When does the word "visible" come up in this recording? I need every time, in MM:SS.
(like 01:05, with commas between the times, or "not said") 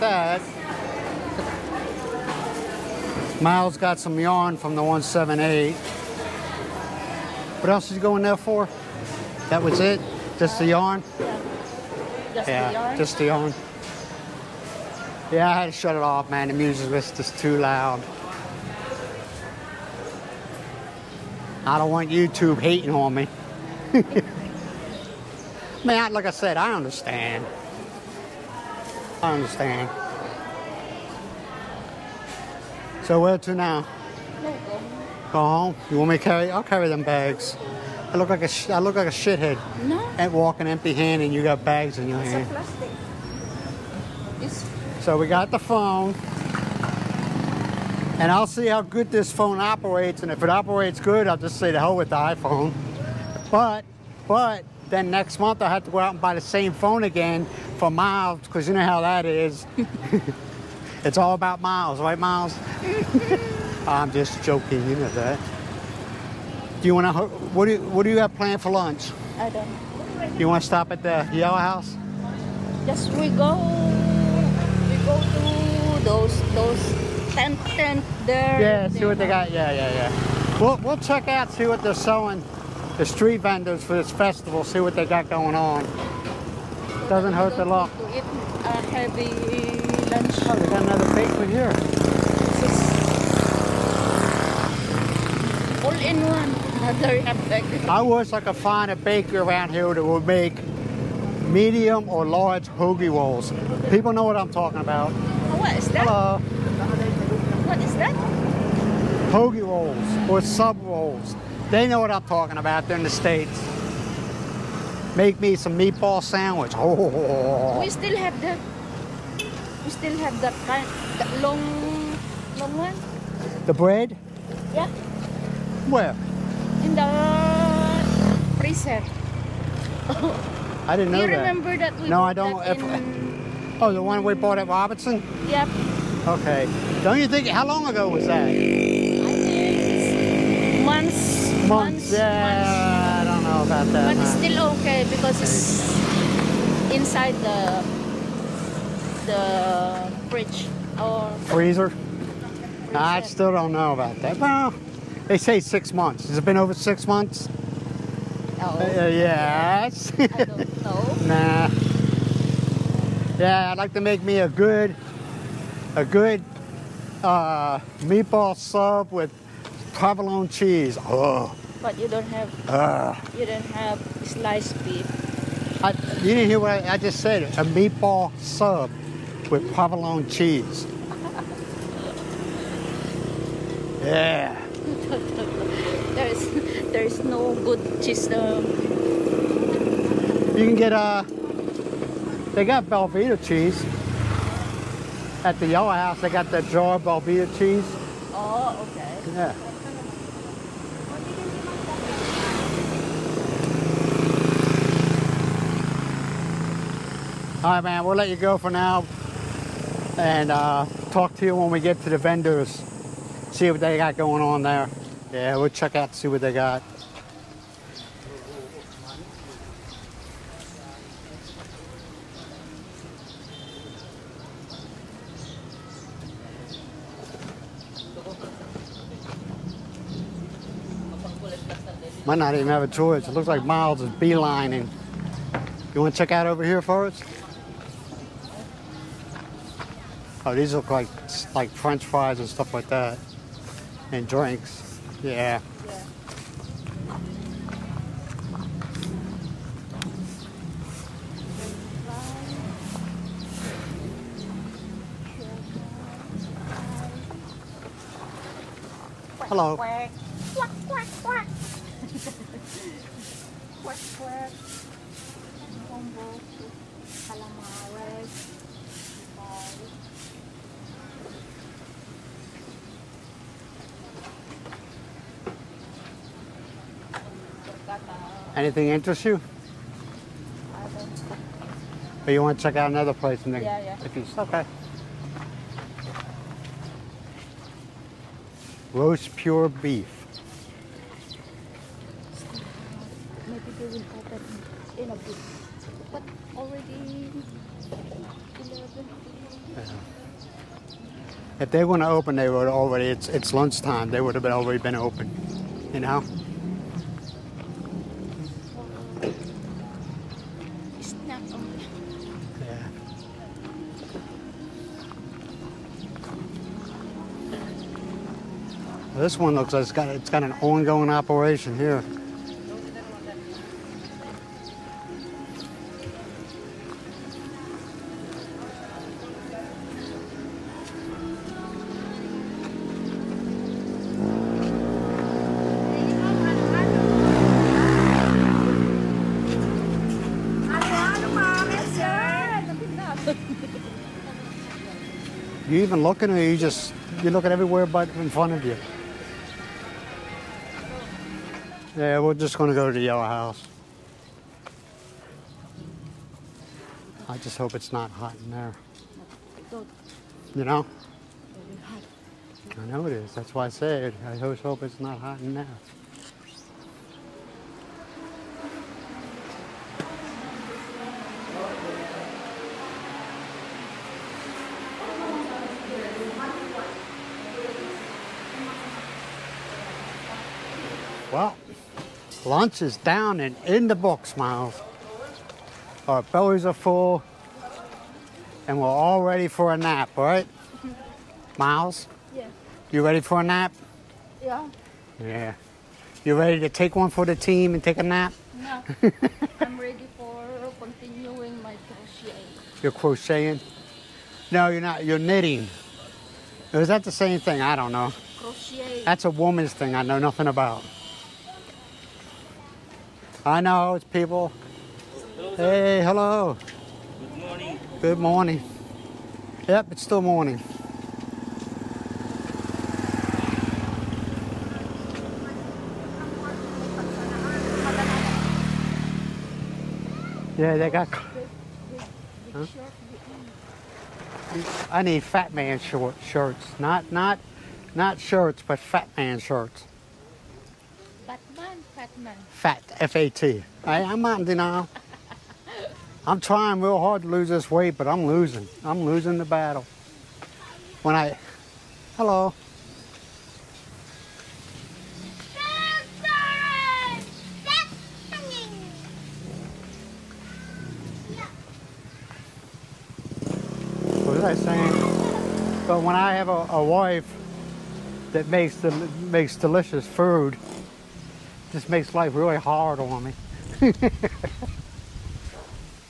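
not said.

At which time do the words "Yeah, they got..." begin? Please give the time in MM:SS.
07:10.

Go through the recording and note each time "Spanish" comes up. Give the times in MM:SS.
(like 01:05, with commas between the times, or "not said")
not said.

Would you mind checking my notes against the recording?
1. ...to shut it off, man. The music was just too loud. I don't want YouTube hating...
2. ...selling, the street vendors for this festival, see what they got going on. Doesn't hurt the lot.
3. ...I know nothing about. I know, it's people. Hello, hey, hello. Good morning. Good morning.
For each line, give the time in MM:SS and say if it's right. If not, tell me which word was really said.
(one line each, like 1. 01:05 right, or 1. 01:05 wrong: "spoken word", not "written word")
1. 00:15 right
2. 01:21 right
3. 06:49 right.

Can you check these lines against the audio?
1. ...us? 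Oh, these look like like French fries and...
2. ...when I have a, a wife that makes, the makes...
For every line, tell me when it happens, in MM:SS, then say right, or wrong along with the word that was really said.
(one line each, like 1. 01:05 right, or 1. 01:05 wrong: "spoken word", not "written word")
1. 03:57 right
2. 07:46 right.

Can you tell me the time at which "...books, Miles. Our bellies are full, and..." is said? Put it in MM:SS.
06:23.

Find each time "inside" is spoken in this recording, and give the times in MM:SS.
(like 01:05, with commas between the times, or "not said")
02:26.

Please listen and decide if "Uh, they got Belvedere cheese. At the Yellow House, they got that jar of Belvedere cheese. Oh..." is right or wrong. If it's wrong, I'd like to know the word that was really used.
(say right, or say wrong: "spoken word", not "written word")
right.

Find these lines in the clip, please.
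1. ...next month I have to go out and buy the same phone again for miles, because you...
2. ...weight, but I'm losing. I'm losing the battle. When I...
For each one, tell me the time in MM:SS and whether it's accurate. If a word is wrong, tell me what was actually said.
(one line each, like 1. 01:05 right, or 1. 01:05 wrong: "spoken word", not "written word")
1. 00:55 right
2. 07:27 right.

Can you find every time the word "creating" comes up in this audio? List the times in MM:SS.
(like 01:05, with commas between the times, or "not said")
not said.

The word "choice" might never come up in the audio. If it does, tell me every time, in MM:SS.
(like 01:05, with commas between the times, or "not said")
03:52.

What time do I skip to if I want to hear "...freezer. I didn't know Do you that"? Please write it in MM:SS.
02:08.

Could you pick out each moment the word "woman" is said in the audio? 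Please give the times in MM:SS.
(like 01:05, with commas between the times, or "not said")
06:49.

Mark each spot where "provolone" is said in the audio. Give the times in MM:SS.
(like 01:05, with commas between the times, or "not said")
02:49, 02:59.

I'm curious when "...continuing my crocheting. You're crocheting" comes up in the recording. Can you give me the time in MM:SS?
06:40.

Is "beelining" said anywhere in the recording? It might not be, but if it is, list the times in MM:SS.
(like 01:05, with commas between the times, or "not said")
03:54.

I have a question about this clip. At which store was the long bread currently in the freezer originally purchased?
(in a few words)
Robinsons.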